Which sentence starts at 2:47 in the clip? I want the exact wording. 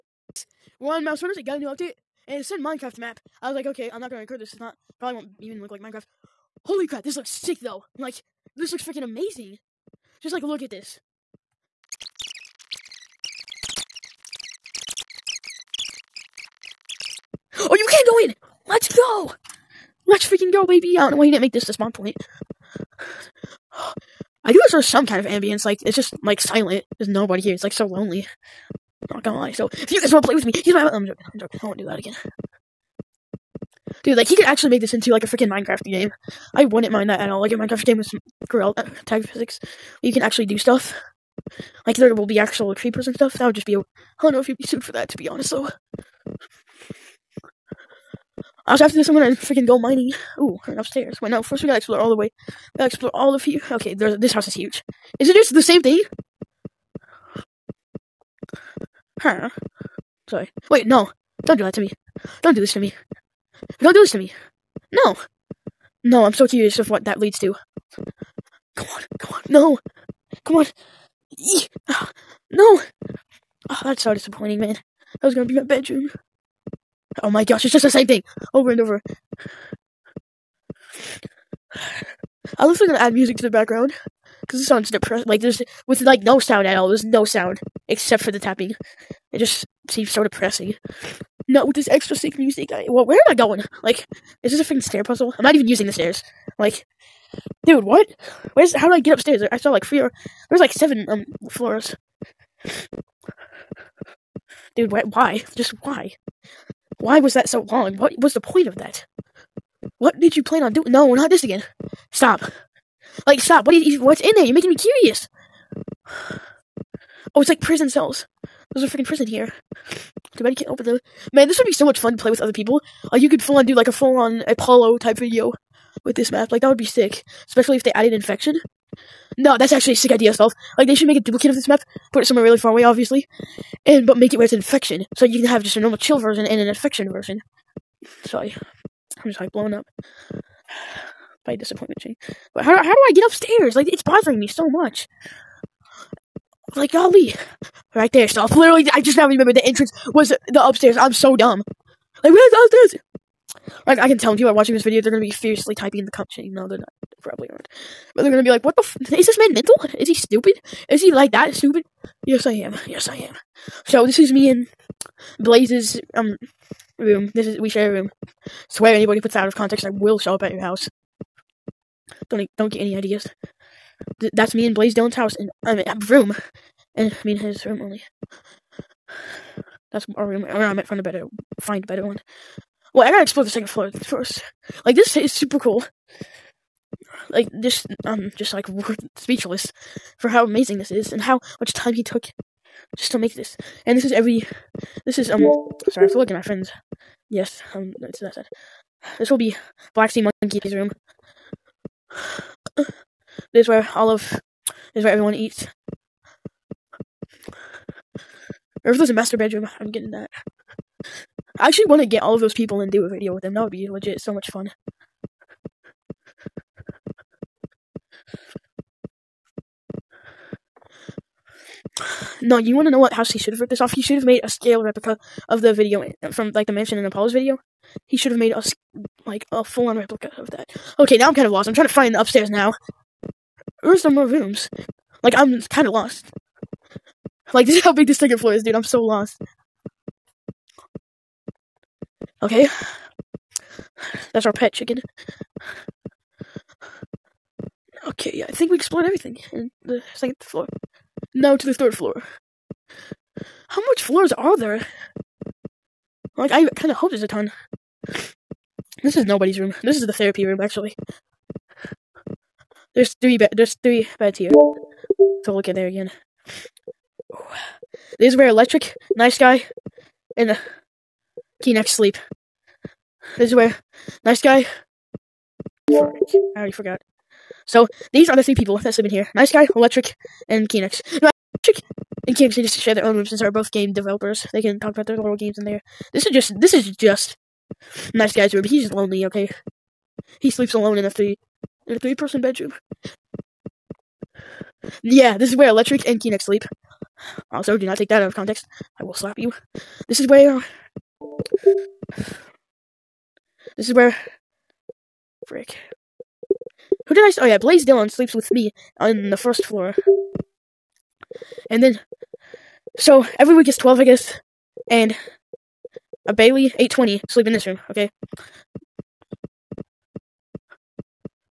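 This is we share a room.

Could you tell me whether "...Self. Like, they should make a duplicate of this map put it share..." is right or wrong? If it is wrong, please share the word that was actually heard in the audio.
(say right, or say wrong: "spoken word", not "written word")
wrong: "somewhere", not "share".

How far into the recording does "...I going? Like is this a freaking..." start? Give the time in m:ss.
1:33.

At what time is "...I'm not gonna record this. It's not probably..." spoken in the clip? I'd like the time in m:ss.
0:03.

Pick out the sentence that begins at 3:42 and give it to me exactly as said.
No, you want to know what house he should have ripped this off?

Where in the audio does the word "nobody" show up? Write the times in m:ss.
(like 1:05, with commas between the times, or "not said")
0:27, 4:19.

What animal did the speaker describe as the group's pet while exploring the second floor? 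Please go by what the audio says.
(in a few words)
Chicken.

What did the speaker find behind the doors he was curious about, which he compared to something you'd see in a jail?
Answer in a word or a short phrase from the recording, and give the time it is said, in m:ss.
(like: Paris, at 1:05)
Prison cells, at 1:57.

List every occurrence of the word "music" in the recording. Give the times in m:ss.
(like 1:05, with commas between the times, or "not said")
1:23, 1:32.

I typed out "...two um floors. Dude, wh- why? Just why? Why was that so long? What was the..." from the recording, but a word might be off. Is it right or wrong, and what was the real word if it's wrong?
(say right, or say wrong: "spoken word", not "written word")
wrong: "seven", not "two".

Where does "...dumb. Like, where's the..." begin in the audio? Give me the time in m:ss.
2:31.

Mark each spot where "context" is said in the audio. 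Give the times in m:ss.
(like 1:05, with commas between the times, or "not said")
2:49, 4:58.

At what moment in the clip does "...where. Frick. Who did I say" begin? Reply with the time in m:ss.
5:03.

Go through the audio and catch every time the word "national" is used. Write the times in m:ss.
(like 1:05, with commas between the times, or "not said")
not said.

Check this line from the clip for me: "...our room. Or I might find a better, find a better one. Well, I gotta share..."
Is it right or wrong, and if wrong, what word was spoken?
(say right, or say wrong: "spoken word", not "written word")
wrong: "explore", not "share".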